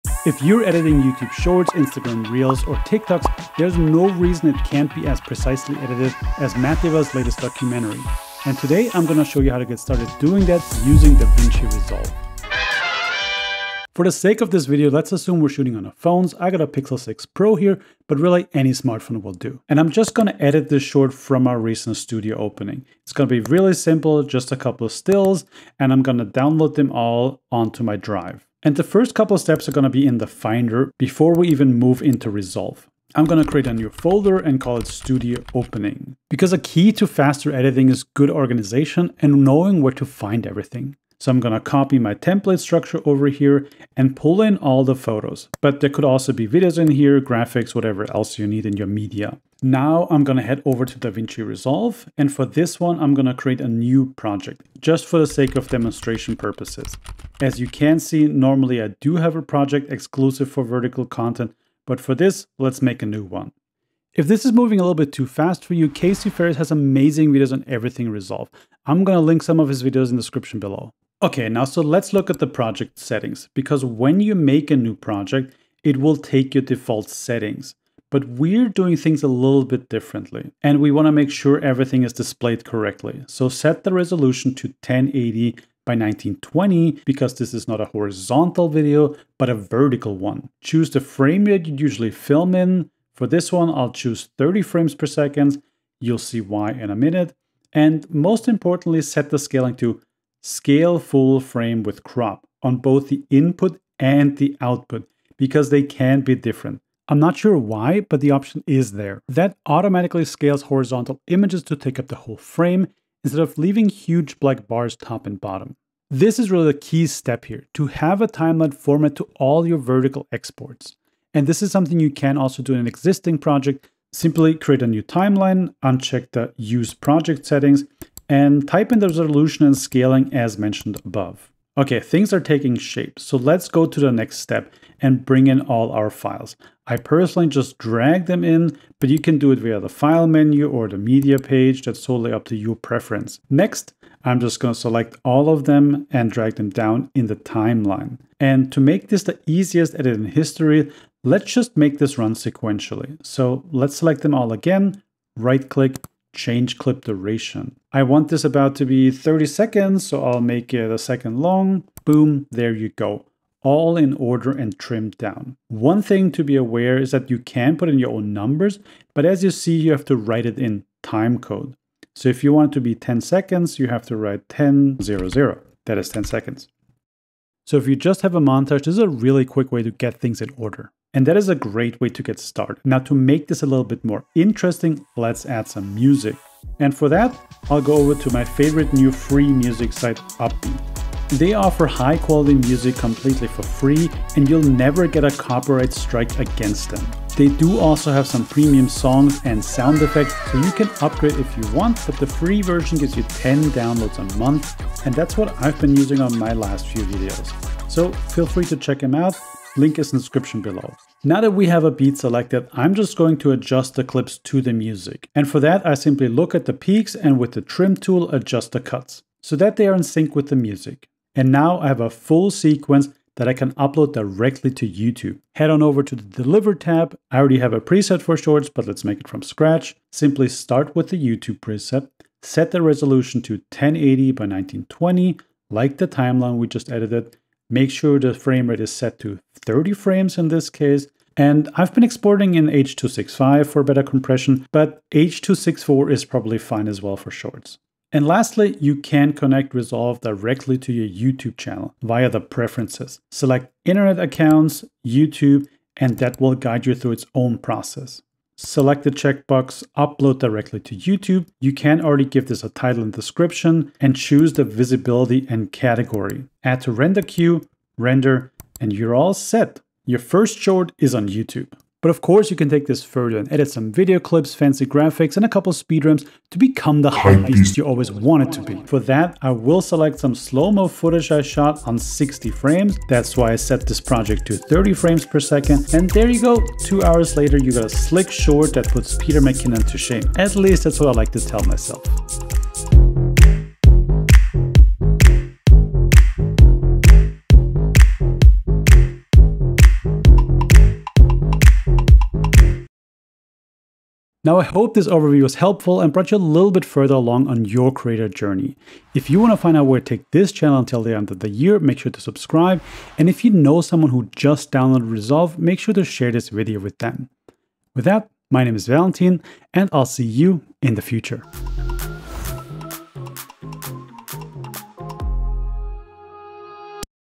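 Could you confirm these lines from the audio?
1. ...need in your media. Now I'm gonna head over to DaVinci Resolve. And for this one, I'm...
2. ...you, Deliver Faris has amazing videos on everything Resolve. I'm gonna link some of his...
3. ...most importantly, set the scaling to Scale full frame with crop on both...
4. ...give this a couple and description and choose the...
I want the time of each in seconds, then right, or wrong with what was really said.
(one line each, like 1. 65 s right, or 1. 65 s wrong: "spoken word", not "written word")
1. 48 s right
2. 65 s wrong: "Casey", not "Deliver"
3. 98 s right
4. 262 s wrong: "title", not "couple".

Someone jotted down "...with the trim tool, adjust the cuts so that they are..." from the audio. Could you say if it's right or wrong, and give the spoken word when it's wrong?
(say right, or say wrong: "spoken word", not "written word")
right.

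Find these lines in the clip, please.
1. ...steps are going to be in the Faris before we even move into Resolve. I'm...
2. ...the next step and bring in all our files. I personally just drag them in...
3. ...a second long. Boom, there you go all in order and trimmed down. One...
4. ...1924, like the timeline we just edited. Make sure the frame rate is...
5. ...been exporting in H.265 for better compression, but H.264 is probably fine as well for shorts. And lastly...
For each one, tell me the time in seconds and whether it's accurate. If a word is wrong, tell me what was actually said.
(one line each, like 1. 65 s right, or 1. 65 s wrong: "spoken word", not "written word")
1. 29 s wrong: "Finder", not "Faris"
2. 133 s right
3. 160 s right
4. 234 s wrong: "1920", not "1924"
5. 241 s right.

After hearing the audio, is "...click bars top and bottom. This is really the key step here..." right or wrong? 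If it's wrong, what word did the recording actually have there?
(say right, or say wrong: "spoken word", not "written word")
wrong: "black", not "click".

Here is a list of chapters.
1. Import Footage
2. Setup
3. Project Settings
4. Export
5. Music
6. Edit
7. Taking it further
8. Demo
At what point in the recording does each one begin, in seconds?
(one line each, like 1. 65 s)
1. 131 s
2. 13 s
3. 71 s
4. 221 s
5. 200 s
6. 143 s
7. 271 s
8. 292 s.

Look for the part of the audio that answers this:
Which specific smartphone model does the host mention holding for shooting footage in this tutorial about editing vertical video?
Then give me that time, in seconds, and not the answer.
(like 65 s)
16 s.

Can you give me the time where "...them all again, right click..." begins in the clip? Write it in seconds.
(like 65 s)
154 s.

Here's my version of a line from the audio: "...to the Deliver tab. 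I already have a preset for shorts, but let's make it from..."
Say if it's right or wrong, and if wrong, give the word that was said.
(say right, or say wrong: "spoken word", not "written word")
right.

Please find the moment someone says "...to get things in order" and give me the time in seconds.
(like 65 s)
179 s.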